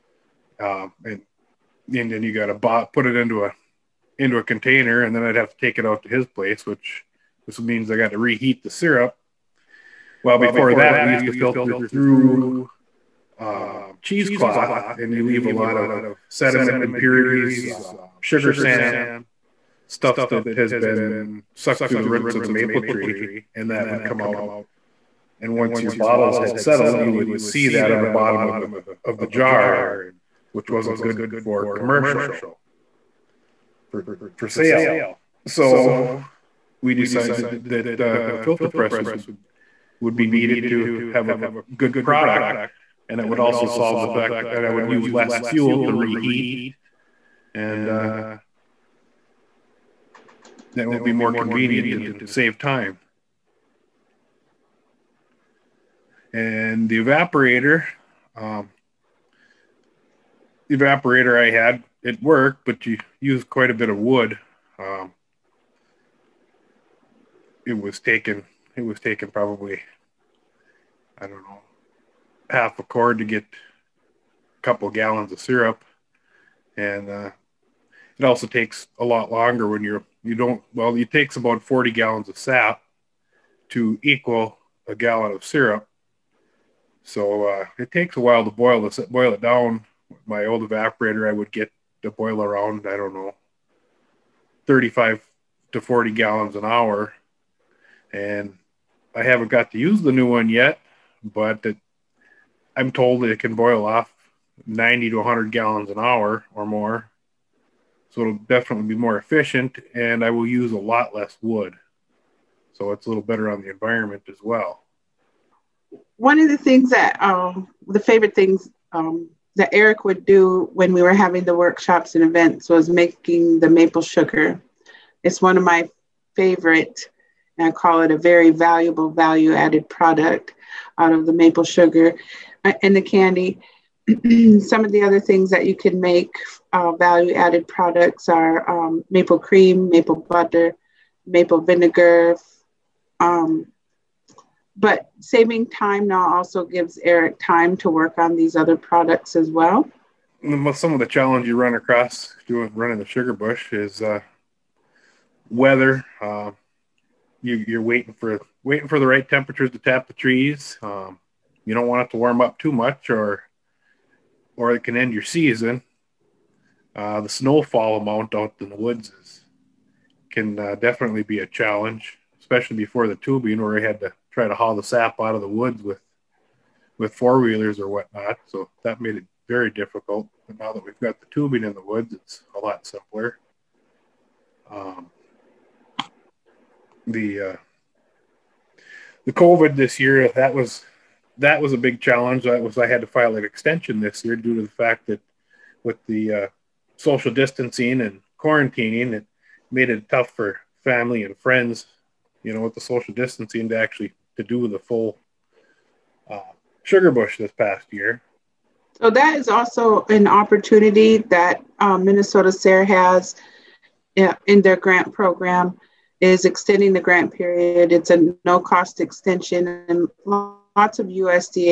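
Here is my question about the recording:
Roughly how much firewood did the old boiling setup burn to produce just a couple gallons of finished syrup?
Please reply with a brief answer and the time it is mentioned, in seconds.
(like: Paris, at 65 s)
half a cord, at 72 s.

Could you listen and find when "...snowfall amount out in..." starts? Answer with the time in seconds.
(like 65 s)
167 s.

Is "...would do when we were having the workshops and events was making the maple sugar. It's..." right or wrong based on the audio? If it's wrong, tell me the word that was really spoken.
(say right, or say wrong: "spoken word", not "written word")
right.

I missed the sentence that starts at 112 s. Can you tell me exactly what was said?
So it's a little better on the environment as well.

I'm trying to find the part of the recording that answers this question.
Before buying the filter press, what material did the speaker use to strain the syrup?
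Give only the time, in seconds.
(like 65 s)
14 s.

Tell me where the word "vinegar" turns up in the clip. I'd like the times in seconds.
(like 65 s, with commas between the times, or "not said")
141 s.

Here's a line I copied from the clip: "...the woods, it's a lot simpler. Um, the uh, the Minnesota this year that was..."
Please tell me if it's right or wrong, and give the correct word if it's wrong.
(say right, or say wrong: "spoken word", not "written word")
wrong: "COVID", not "Minnesota".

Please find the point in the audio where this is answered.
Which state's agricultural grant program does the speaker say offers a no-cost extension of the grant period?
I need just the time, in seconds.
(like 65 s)
212 s.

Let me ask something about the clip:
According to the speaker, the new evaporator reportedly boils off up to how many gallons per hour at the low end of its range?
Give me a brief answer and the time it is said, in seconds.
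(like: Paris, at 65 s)
90, at 104 s.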